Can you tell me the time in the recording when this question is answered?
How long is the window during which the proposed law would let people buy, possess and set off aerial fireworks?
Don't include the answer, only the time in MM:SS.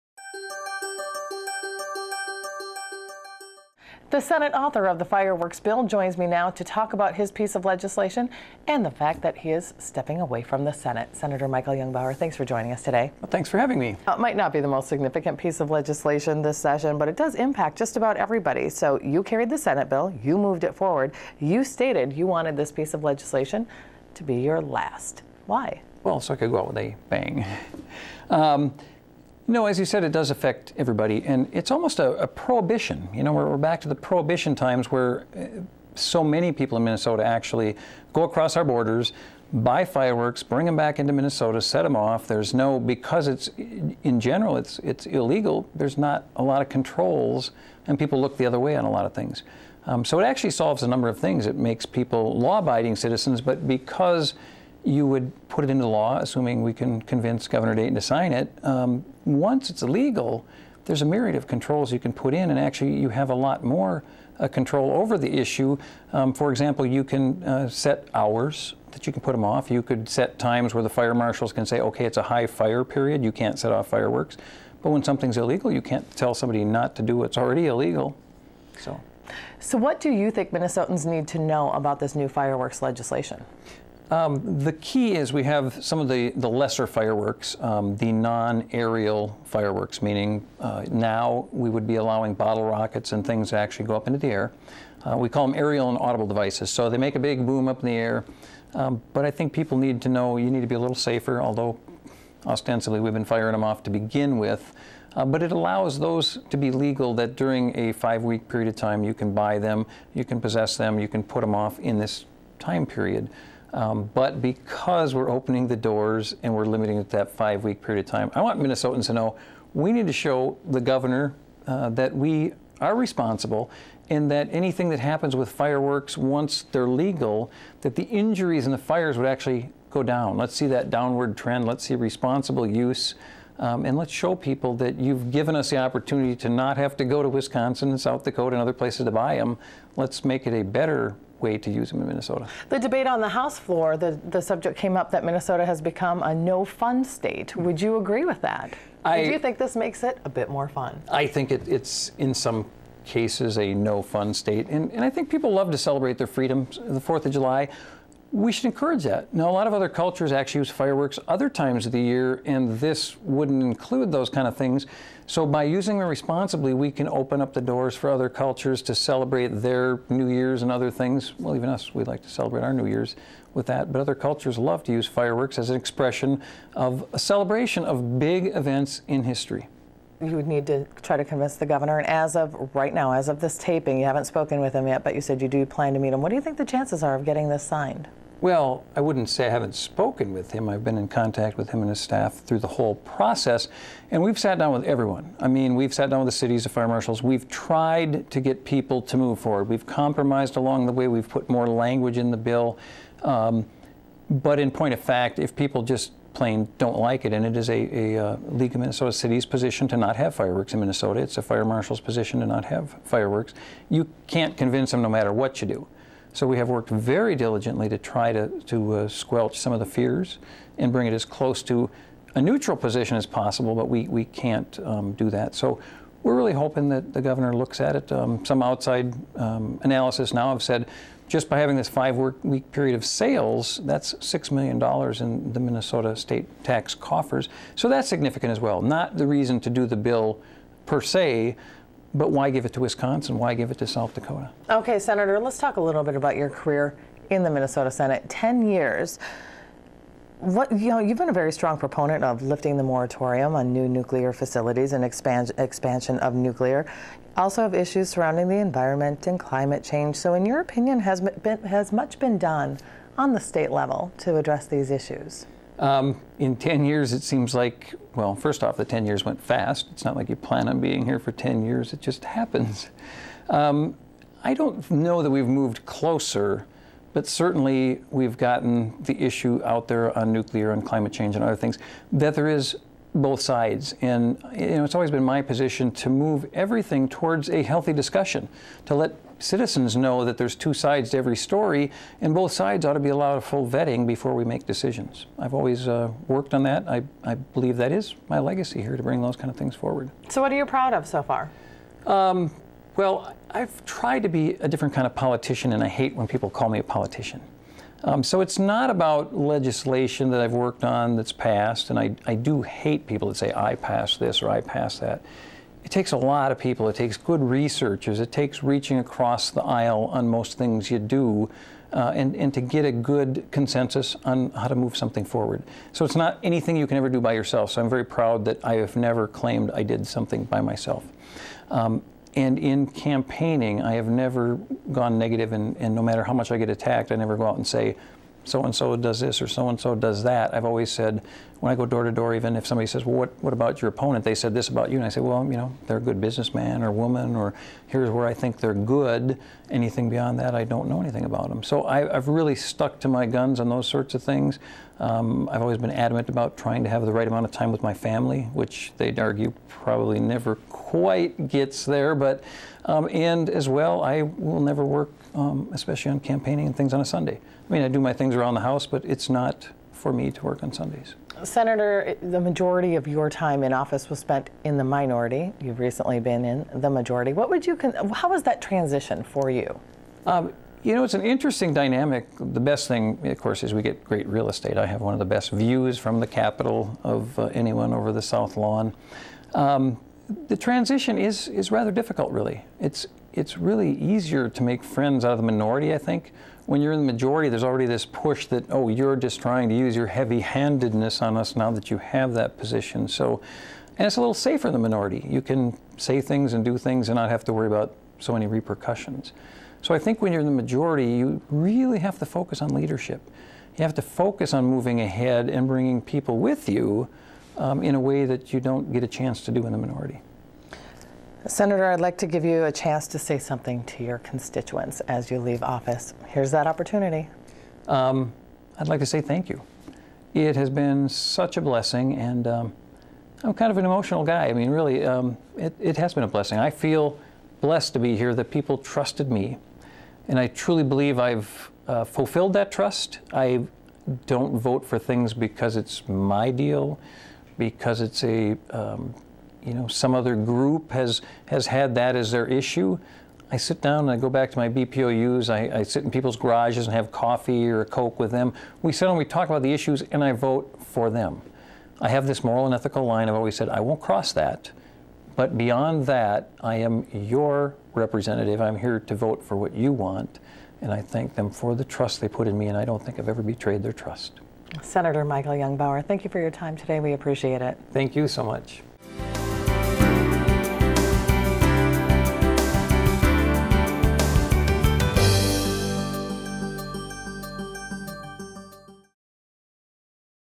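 01:47.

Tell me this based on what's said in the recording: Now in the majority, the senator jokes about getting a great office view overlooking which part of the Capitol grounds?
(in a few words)
South Lawn.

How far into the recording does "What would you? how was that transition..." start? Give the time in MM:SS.
06:17.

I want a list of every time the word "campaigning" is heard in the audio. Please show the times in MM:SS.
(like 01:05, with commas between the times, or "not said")
05:32, 06:06.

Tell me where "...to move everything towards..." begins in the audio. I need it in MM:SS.
04:45.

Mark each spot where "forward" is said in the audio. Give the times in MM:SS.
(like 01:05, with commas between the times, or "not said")
00:20, 03:19, 04:59, 05:25.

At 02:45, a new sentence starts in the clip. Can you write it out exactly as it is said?
So, by using them responsibly, we can open up the doors for other cultures to celebrate their New Year's and other things.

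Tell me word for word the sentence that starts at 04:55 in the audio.
I've always uh, worked on that.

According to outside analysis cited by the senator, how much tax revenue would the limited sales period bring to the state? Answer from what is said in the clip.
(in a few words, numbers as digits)
$6 million.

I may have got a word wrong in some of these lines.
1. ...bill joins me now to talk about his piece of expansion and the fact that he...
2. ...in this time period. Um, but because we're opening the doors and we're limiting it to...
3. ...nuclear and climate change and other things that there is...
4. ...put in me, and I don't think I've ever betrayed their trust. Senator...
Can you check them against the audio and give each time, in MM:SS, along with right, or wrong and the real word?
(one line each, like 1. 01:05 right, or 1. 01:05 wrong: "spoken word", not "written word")
1. 00:05 wrong: "legislation", not "expansion"
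2. 01:51 right
3. 04:40 right
4. 07:52 right.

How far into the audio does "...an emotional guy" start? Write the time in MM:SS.
07:13.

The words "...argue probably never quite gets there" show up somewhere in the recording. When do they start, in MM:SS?
05:59.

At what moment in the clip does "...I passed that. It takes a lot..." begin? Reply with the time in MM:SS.
05:14.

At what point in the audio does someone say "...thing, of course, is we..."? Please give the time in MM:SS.
06:22.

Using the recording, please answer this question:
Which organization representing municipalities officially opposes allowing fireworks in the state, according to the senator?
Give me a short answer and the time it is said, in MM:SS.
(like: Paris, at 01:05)
League of Minnesota Cities, at 03:28.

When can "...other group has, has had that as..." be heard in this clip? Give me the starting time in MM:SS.
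07:30.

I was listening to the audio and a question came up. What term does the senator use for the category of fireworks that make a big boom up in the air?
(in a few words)
aerial and audible devices.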